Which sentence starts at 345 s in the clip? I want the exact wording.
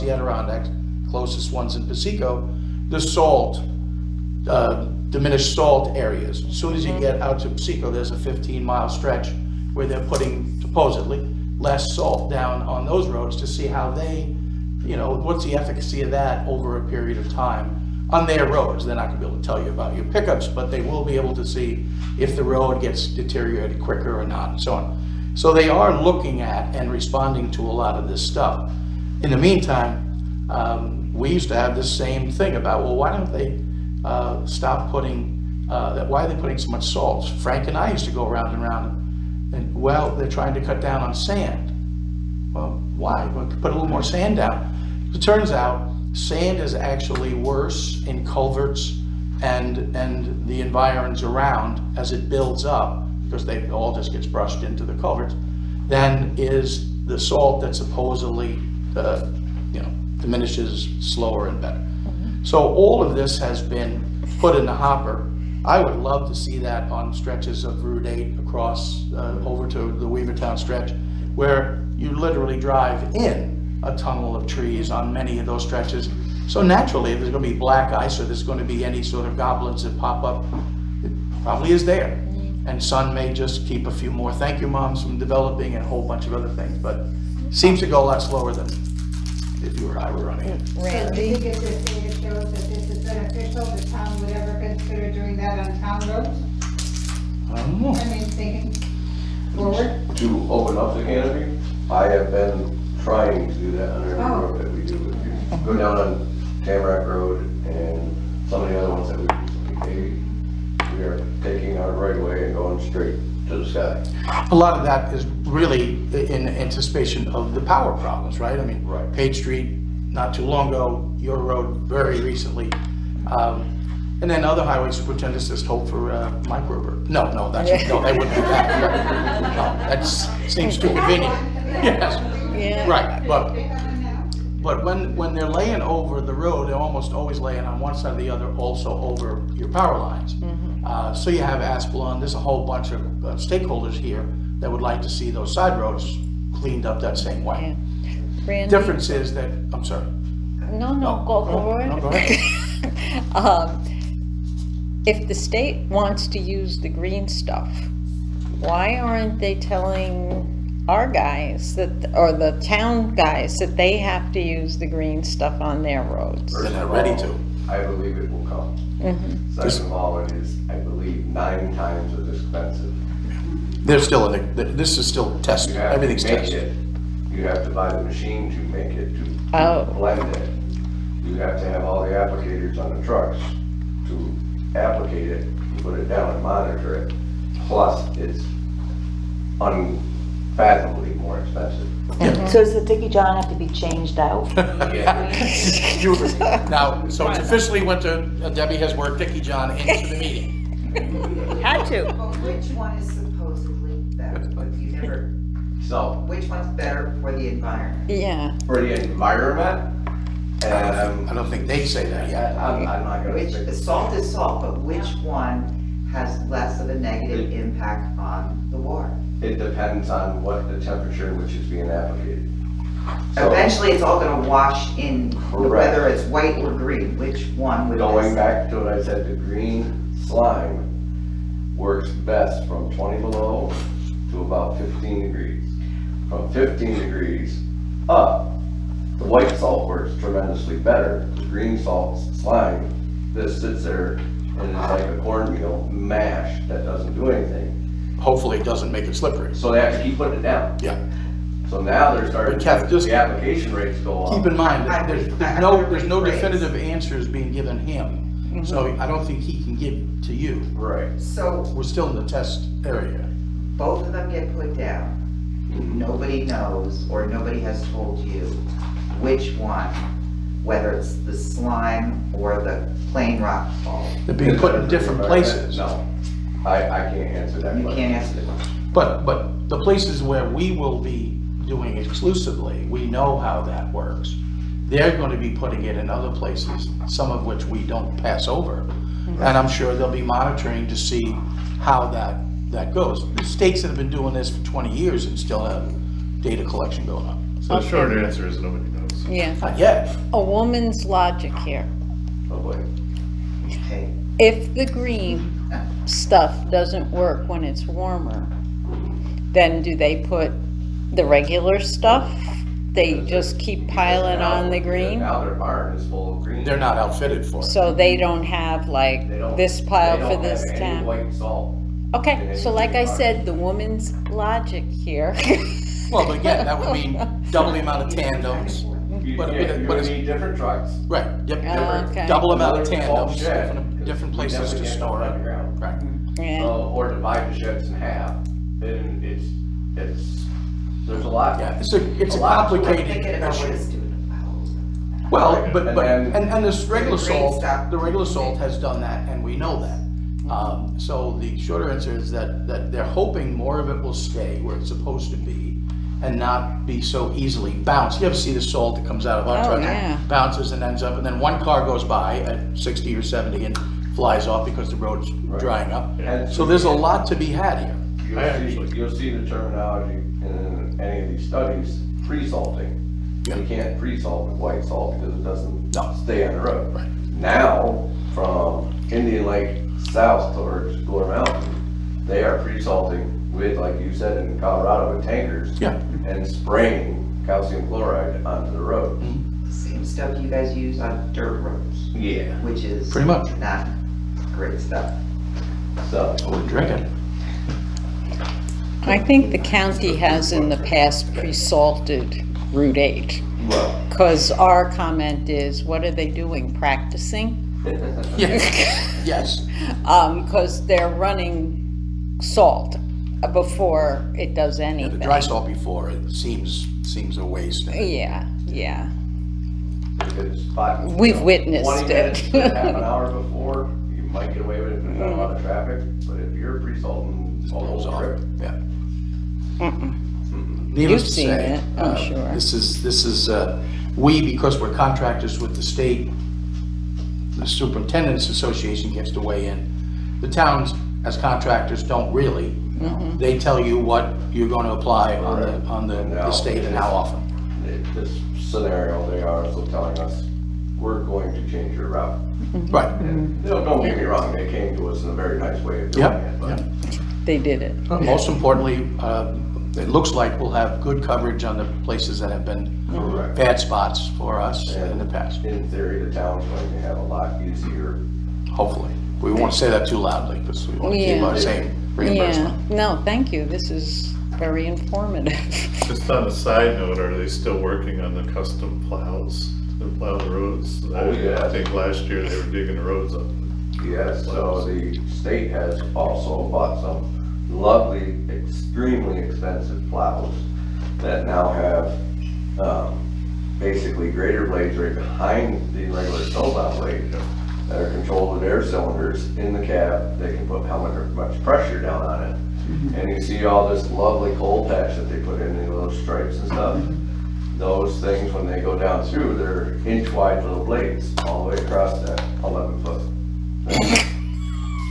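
Well, but, and but, then, and, and this regular salt, the regular salt mm-hmm.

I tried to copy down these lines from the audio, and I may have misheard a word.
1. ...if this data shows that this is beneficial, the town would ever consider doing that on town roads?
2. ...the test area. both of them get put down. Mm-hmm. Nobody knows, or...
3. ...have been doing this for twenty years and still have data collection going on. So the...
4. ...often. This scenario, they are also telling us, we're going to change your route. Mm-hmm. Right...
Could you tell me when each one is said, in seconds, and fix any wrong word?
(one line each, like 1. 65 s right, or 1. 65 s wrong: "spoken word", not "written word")
1. 91 s right
2. 262 s right
3. 293 s right
4. 447 s right.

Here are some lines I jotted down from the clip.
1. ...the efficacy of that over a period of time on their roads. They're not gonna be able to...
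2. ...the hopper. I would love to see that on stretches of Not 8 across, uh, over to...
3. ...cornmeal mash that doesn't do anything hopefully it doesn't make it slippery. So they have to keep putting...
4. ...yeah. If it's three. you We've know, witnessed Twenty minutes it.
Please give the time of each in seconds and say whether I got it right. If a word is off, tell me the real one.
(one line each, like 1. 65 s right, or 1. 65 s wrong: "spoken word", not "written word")
1. 15 s right
2. 64 s wrong: "Route", not "Not"
3. 245 s right
4. 418 s wrong: "five", not "three".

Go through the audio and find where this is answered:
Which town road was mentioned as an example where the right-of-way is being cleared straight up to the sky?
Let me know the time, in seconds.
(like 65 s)
106 s.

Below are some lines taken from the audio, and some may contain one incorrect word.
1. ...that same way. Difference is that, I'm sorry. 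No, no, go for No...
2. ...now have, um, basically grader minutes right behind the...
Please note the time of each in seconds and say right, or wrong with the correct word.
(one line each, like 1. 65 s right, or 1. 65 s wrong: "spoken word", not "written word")
1. 146 s right
2. 491 s wrong: "blades", not "minutes".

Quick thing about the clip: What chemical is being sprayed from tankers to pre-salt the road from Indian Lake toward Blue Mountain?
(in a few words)
Calcium chloride.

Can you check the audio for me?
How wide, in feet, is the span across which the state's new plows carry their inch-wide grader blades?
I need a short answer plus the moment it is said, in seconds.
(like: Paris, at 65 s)
11 feet, at 512 s.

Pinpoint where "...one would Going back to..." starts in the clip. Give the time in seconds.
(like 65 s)
227 s.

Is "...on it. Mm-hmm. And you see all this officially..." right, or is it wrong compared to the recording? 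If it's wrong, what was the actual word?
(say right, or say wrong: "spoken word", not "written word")
wrong: "lovely", not "officially".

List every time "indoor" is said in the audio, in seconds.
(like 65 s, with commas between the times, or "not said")
not said.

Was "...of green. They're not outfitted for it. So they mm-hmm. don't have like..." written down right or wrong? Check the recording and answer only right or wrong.
right.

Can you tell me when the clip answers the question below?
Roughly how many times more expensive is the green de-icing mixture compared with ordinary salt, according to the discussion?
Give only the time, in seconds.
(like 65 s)
171 s.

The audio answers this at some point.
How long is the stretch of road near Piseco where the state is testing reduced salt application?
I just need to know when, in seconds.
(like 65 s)
8 s.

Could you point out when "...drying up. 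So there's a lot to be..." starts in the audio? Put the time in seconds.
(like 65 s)
365 s.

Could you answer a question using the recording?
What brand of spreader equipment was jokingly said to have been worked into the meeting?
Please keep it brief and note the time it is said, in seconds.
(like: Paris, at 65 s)
DICKEY-john, at 199 s.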